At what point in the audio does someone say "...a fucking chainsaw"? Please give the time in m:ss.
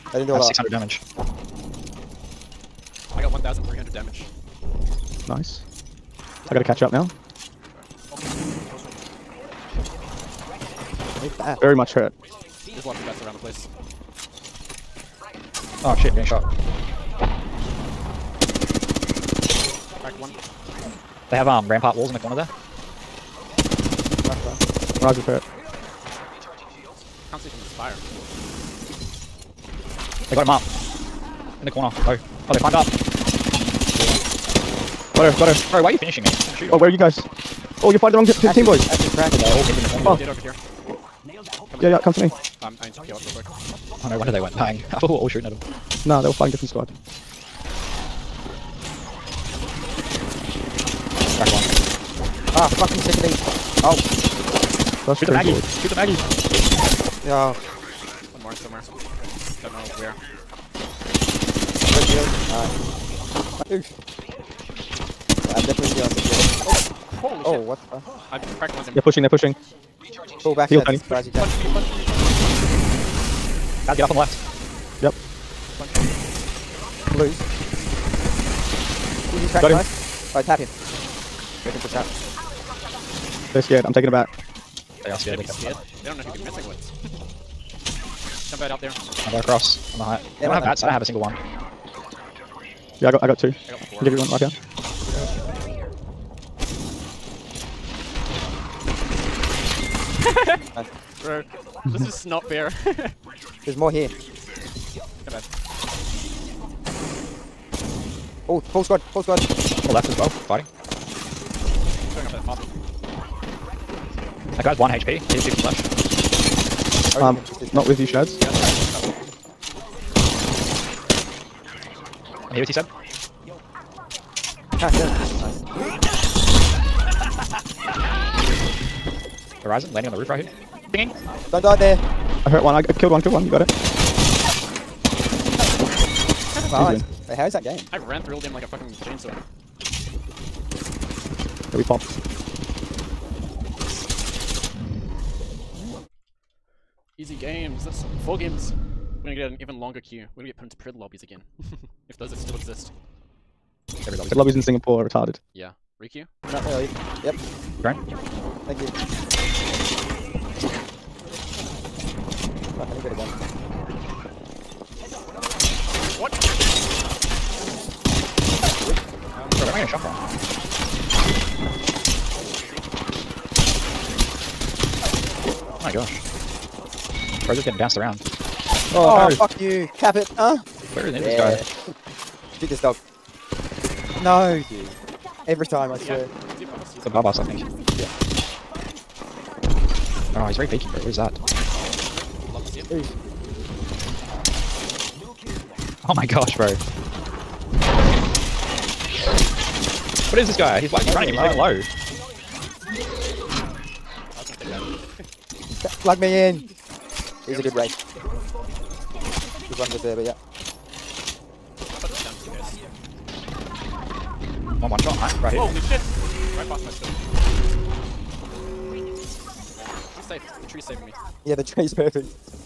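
2:18.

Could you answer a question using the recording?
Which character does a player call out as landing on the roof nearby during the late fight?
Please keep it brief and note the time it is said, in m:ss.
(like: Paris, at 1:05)
Horizon, at 2:09.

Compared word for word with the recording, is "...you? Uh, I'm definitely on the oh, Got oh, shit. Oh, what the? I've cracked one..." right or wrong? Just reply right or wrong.
wrong.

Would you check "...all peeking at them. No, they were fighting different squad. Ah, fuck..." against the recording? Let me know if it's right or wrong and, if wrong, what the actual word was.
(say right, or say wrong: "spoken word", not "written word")
wrong: "shooting", not "peeking".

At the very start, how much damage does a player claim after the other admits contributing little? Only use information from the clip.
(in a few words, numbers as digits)
1,300.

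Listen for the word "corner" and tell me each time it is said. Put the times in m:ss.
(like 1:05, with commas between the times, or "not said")
0:22, 0:31, 0:41.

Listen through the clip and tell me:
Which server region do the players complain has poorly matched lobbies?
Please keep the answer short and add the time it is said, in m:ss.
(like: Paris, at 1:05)
Singapore, at 2:34.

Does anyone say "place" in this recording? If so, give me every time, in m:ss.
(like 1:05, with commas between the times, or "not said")
0:13.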